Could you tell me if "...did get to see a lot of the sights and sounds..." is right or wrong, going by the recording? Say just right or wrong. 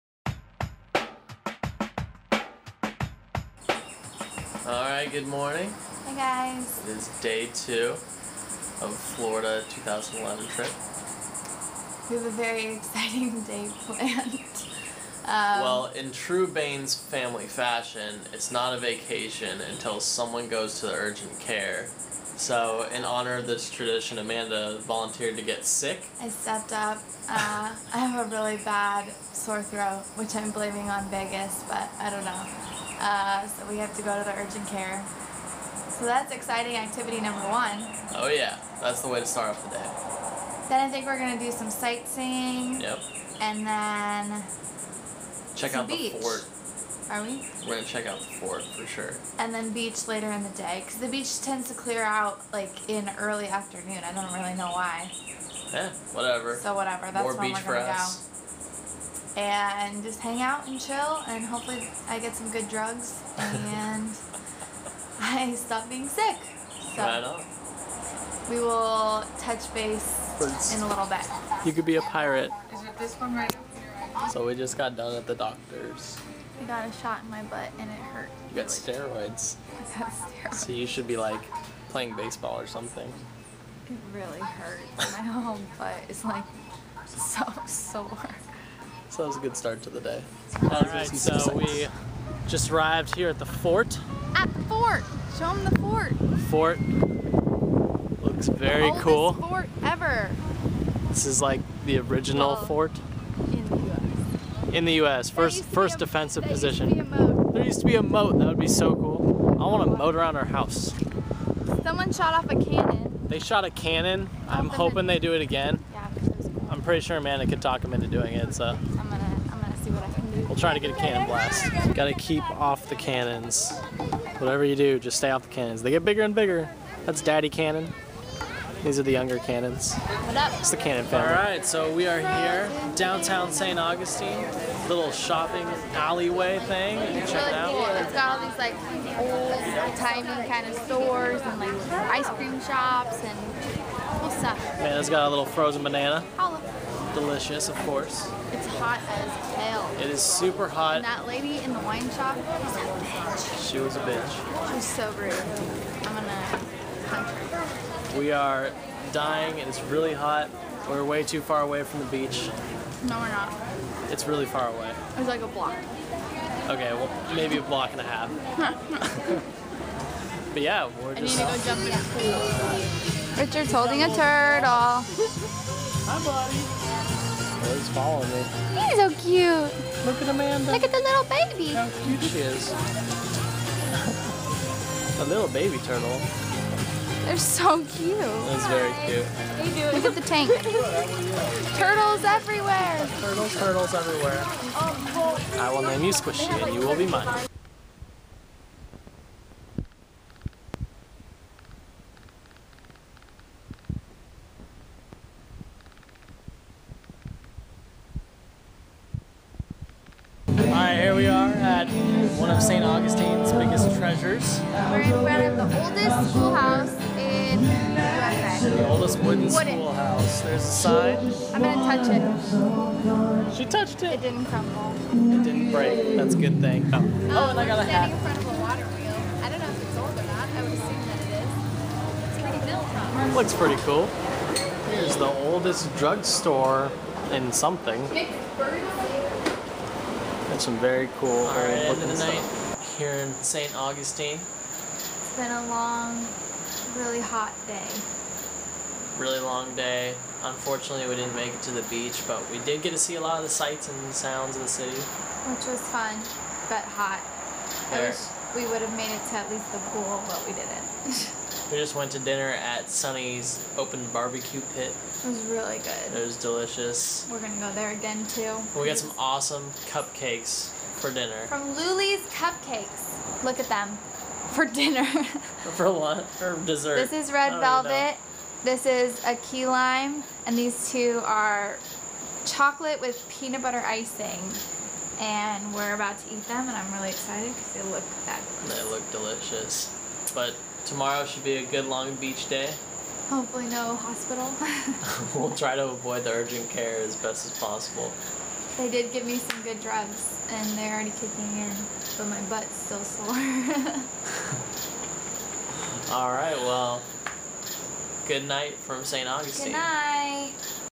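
right.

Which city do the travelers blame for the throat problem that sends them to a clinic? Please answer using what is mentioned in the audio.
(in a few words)
Vegas.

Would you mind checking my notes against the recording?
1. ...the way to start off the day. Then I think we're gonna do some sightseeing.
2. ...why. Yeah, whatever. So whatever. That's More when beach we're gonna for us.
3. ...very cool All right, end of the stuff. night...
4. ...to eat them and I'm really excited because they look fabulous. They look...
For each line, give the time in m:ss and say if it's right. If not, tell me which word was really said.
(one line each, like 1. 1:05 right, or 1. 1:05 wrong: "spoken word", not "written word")
1. 0:39 right
2. 0:54 right
3. 4:00 right
4. 4:46 right.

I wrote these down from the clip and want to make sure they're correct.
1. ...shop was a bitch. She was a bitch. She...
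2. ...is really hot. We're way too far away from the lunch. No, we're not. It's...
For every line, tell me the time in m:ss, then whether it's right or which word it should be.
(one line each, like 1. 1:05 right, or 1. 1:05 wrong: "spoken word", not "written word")
1. 2:32 right
2. 2:39 wrong: "beach", not "lunch".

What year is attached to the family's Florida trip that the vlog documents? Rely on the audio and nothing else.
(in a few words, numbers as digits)
2011.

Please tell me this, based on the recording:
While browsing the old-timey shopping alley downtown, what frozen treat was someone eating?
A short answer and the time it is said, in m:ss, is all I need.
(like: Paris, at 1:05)
frozen banana, at 2:25.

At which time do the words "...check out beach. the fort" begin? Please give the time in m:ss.
0:45.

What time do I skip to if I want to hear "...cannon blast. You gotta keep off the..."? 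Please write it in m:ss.
2:00.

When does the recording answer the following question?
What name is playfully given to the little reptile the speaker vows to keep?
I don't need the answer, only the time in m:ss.
3:16.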